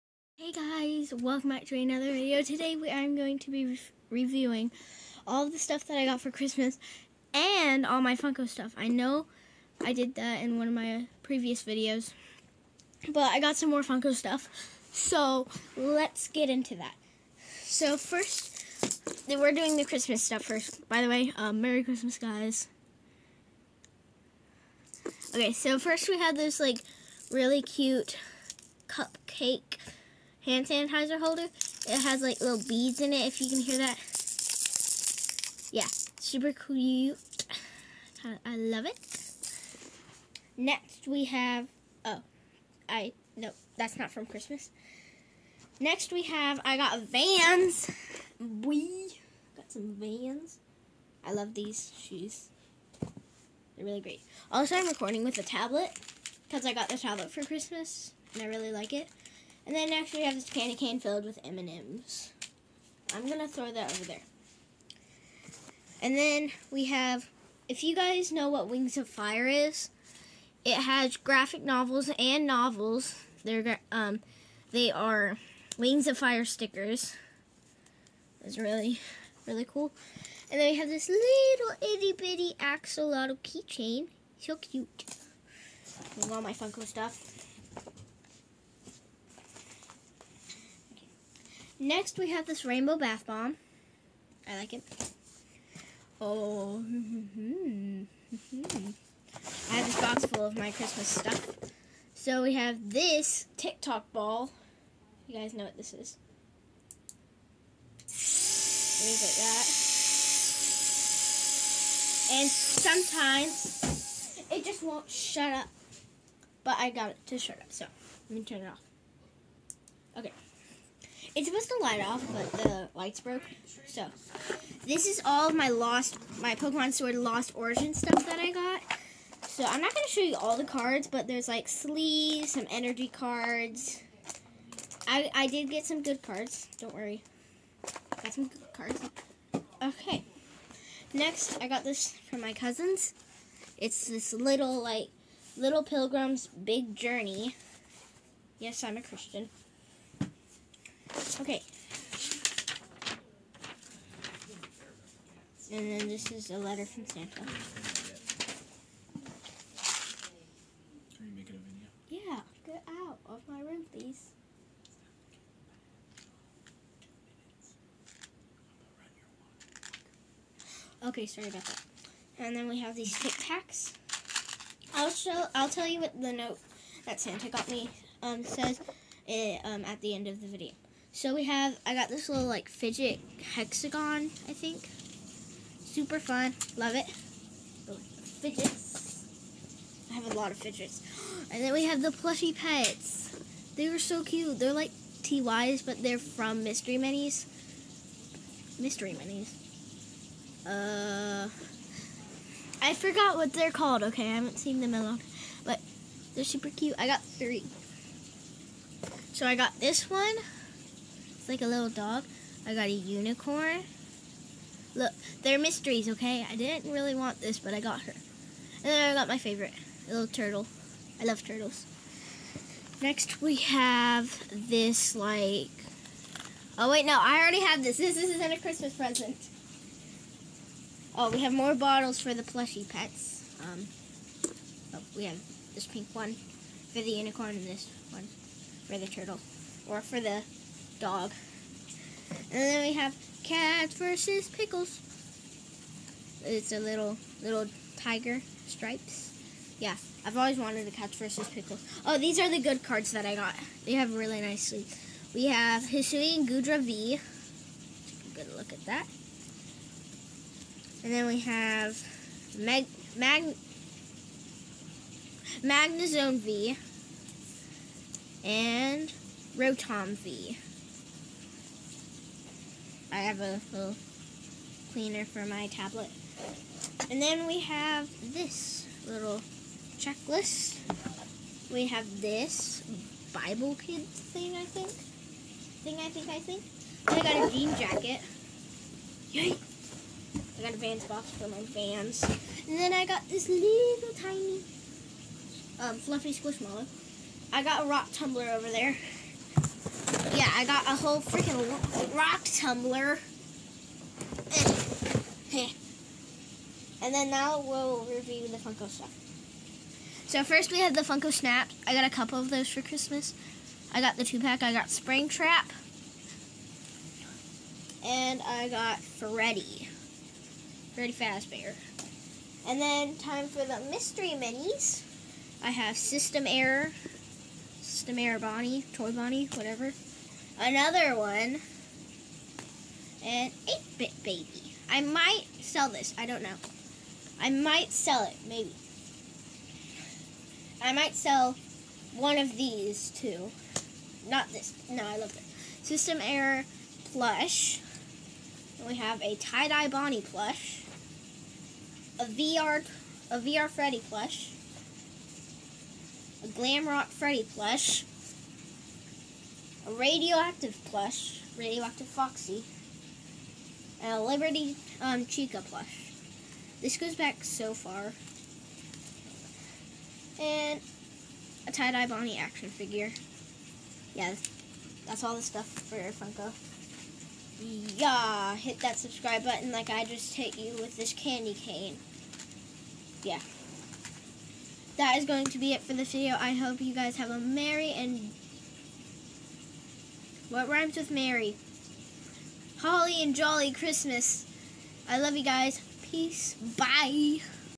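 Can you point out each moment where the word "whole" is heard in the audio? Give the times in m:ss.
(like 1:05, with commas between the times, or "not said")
5:00.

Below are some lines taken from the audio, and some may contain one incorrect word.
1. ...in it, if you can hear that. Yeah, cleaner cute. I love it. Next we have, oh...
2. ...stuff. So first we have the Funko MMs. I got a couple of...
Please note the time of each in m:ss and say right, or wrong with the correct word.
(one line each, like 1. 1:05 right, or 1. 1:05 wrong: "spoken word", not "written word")
1. 0:32 wrong: "super", not "cleaner"
2. 5:08 wrong: "Snap", not "MMs".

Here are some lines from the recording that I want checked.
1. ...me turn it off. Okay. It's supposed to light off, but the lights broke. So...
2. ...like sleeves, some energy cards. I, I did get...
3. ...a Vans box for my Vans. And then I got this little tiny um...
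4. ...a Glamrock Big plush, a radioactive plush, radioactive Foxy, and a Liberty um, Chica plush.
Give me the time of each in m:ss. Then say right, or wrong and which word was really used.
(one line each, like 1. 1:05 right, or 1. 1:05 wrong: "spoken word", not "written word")
1. 1:58 right
2. 2:11 right
3. 4:50 right
4. 5:56 wrong: "Freddy", not "Big".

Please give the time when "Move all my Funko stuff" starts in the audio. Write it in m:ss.
1:26.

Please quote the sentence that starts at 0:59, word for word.
And then next we have this candy cane filled with M&Ms.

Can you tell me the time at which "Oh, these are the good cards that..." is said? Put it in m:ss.
4:12.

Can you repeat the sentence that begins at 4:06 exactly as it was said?
It's a little little tiger stripes.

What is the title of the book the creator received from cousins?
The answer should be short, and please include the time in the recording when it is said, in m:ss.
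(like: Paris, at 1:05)
Little Pilgrim's Big Journey, at 2:25.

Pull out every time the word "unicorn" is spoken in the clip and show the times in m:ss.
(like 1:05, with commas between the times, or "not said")
3:32, 3:57.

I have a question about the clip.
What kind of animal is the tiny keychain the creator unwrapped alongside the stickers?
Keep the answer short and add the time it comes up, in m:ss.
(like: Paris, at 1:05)
Axolotl, at 1:22.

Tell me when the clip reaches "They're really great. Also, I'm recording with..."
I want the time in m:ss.
0:53.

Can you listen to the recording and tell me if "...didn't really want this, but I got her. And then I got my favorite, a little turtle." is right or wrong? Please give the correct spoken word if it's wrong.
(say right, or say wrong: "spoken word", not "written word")
right.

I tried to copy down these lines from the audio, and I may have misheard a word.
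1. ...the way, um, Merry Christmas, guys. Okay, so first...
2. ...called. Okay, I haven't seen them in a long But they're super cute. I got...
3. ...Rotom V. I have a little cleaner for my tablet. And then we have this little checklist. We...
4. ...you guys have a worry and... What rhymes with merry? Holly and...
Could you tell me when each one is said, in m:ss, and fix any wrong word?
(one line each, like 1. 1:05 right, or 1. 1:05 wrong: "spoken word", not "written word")
1. 0:21 right
2. 3:23 right
3. 4:29 right
4. 6:26 wrong: "merry", not "worry".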